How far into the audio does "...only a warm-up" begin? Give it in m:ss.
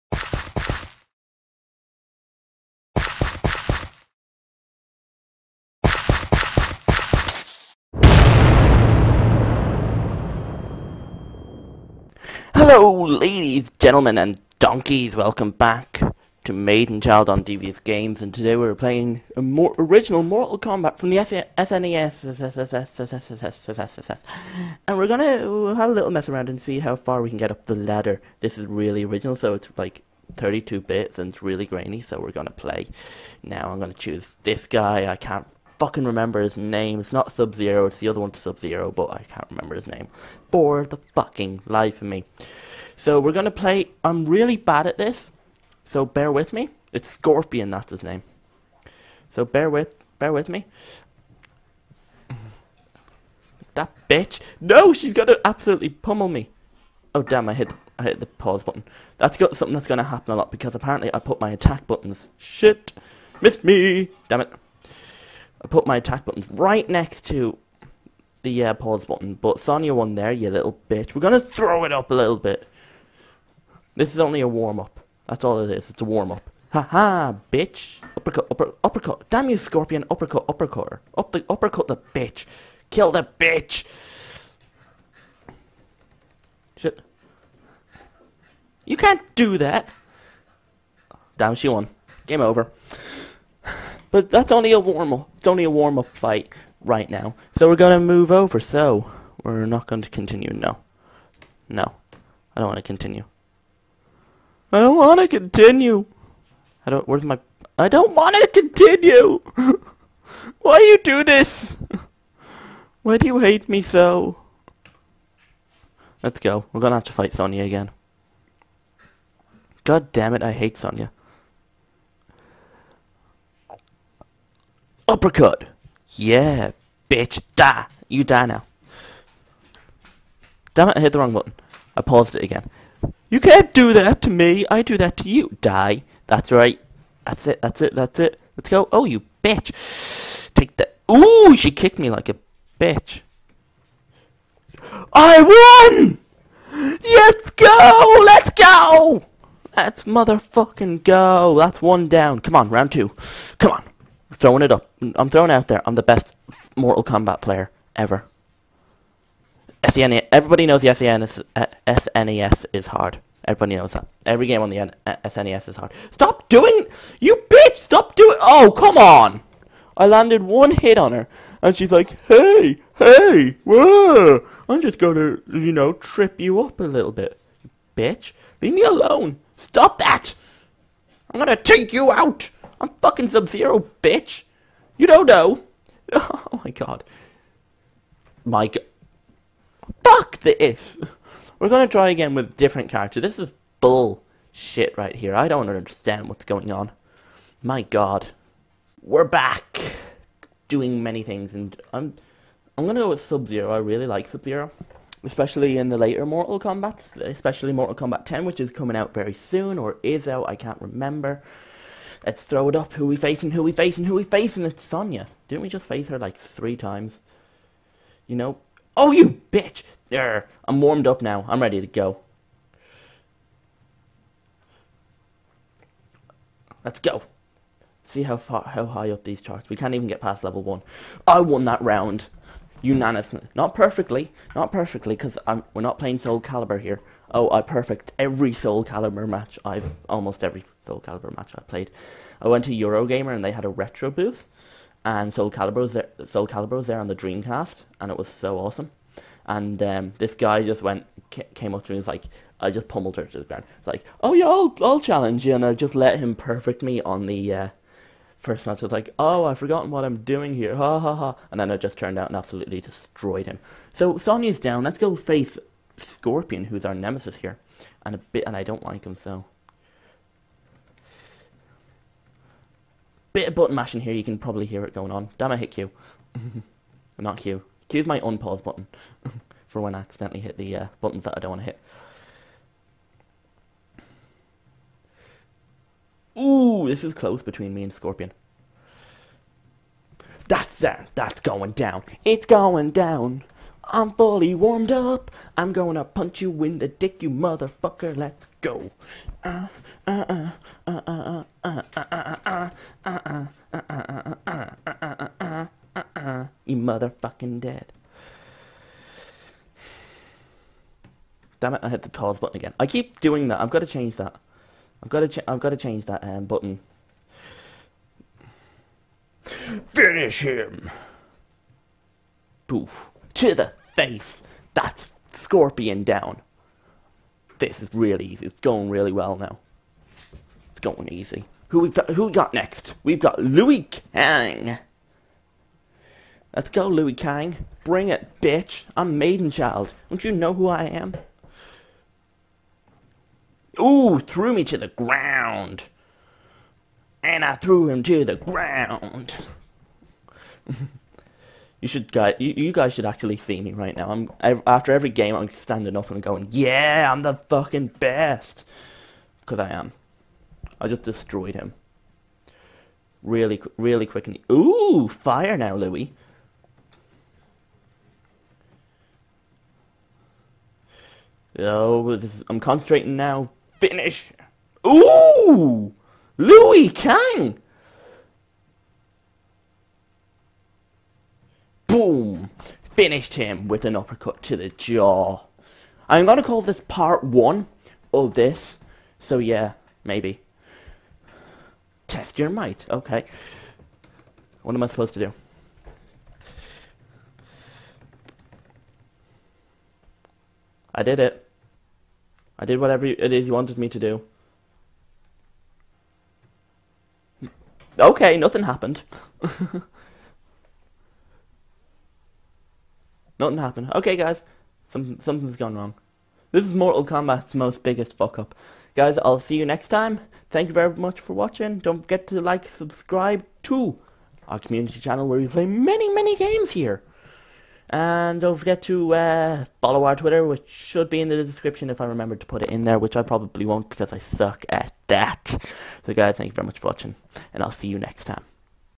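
1:14.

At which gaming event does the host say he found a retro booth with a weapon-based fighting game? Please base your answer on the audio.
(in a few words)
Eurogamer.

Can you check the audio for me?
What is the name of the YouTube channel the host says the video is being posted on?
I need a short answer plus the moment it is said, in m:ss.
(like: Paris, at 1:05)
DeviousGamez, at 0:17.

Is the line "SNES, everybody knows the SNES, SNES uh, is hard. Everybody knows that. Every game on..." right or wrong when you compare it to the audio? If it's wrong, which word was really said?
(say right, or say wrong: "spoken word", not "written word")
right.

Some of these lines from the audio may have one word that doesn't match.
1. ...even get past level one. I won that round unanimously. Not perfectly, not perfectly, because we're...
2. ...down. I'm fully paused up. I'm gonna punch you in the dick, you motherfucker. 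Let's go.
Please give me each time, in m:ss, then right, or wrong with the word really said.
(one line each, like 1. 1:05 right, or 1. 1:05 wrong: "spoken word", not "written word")
1. 3:49 right
2. 4:52 wrong: "warmed", not "paused".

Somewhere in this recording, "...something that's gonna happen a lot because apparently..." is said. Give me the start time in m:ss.
0:59.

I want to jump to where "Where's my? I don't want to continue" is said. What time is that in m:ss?
1:47.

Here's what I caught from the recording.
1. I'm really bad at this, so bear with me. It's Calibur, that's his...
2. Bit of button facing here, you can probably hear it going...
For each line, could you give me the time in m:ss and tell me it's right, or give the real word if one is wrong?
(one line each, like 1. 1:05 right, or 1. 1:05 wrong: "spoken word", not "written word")
1. 0:44 wrong: "Scorpion", not "Calibur"
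2. 4:33 wrong: "mashing", not "facing".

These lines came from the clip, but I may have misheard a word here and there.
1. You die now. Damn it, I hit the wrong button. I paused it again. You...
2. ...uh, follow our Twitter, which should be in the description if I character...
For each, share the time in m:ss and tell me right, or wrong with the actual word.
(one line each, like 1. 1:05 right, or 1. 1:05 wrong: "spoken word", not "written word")
1. 2:08 right
2. 7:09 wrong: "remember", not "character".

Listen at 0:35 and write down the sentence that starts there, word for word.
I can't fucking remember his name.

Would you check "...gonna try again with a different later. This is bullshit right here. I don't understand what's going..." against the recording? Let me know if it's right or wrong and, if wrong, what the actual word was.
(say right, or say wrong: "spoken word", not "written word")
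wrong: "character", not "later".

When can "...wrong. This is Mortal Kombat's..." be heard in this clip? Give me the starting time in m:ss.
6:55.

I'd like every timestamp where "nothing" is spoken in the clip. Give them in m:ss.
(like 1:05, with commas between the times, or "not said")
6:48, 6:53.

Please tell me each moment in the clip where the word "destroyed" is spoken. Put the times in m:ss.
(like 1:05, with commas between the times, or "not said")
4:22, 6:01.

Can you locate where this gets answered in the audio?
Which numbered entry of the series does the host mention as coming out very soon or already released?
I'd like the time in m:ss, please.
3:27.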